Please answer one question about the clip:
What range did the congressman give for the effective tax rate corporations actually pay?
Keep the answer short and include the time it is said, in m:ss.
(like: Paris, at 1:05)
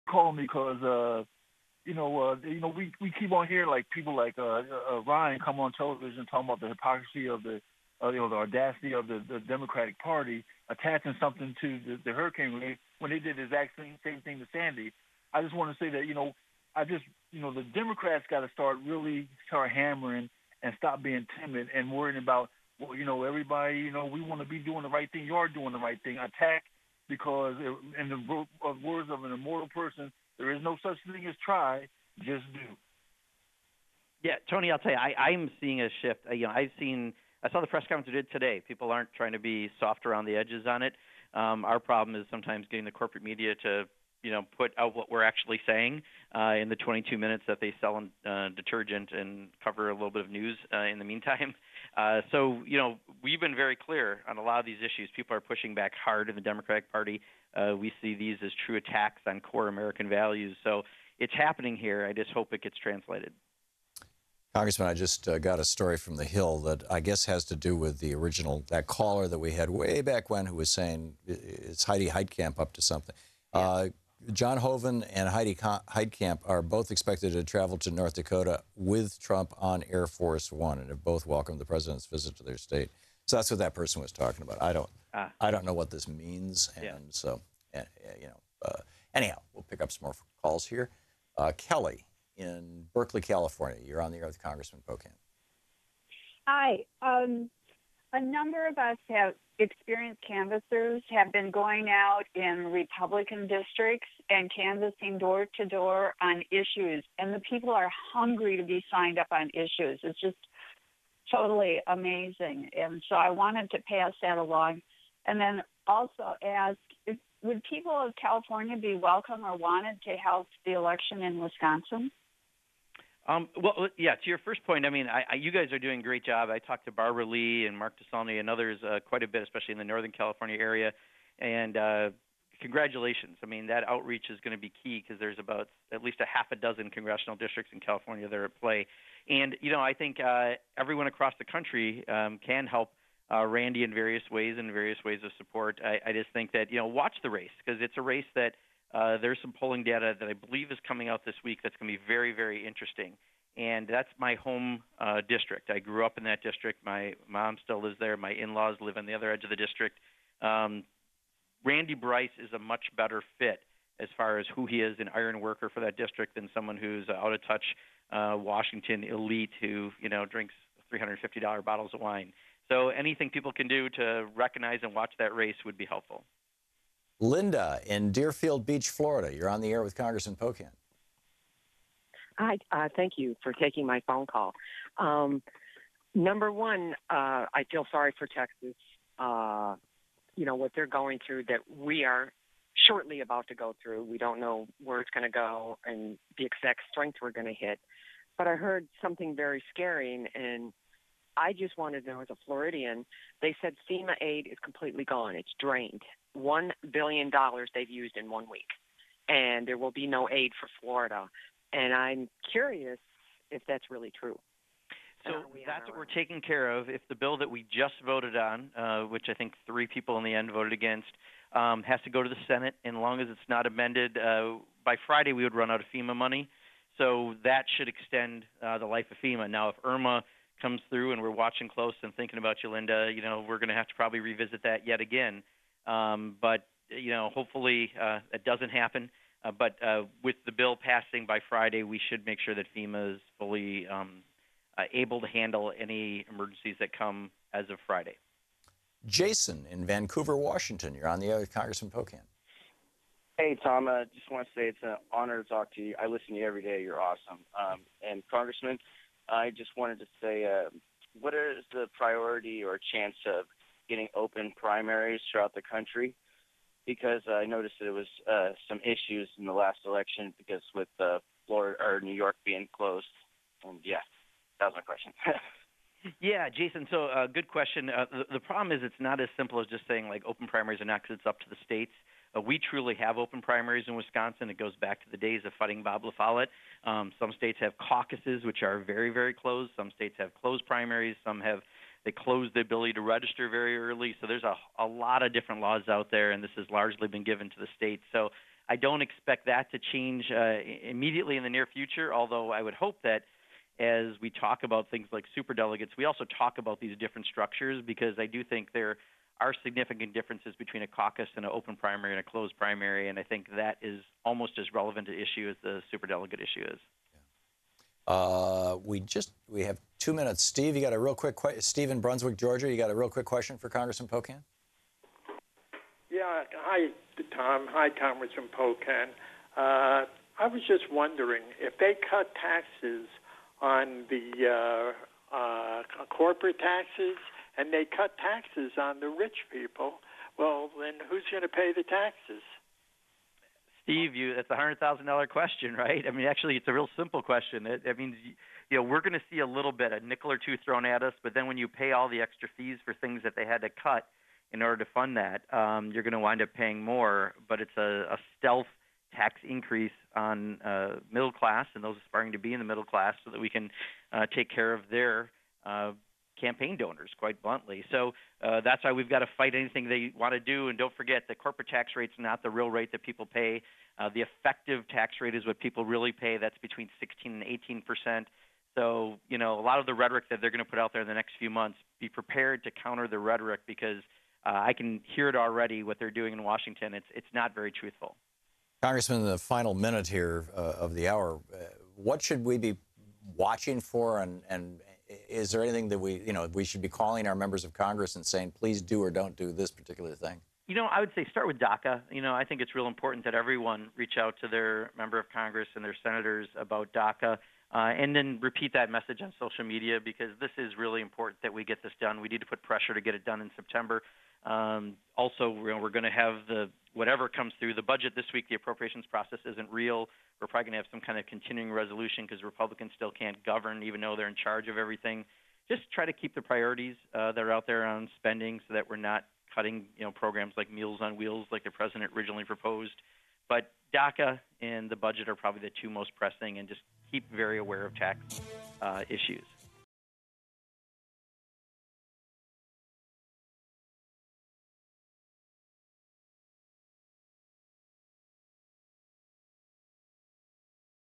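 16 to 18 percent, at 6:16.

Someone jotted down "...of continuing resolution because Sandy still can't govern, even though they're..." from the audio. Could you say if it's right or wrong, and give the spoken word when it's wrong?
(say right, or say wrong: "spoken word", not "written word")
wrong: "Republicans", not "Sandy".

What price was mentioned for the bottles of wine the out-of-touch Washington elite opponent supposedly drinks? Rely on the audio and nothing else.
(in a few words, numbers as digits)
$350.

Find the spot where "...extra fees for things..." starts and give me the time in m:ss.
5:52.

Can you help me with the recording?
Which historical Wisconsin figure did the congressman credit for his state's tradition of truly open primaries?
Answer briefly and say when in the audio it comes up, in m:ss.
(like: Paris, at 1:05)
Bob La Follette, at 4:45.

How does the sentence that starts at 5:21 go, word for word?
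Steve in Brunswick, Georgia, you got a real quick question for Congressman Pocan?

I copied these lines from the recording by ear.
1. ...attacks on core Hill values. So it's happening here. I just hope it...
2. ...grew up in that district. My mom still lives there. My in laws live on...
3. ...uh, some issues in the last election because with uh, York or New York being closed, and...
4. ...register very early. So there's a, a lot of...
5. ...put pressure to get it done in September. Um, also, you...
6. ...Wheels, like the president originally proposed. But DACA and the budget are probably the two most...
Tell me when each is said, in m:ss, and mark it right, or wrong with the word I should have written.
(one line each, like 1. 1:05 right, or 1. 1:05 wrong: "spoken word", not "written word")
1. 0:58 wrong: "American", not "Hill"
2. 2:35 right
3. 4:28 wrong: "Florida", not "York"
4. 4:53 right
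5. 6:52 right
6. 7:11 right.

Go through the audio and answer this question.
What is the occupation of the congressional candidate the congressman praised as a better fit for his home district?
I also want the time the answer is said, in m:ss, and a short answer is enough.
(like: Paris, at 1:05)
Iron worker, at 2:45.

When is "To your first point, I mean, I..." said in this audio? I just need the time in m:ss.
2:04.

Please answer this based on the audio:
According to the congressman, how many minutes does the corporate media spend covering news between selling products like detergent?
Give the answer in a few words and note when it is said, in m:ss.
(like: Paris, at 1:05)
22 minutes, at 0:46.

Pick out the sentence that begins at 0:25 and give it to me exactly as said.
You are doing the right thing.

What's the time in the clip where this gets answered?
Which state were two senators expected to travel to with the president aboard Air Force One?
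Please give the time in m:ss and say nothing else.
1:17.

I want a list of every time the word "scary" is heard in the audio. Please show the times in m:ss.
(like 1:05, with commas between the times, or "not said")
3:19.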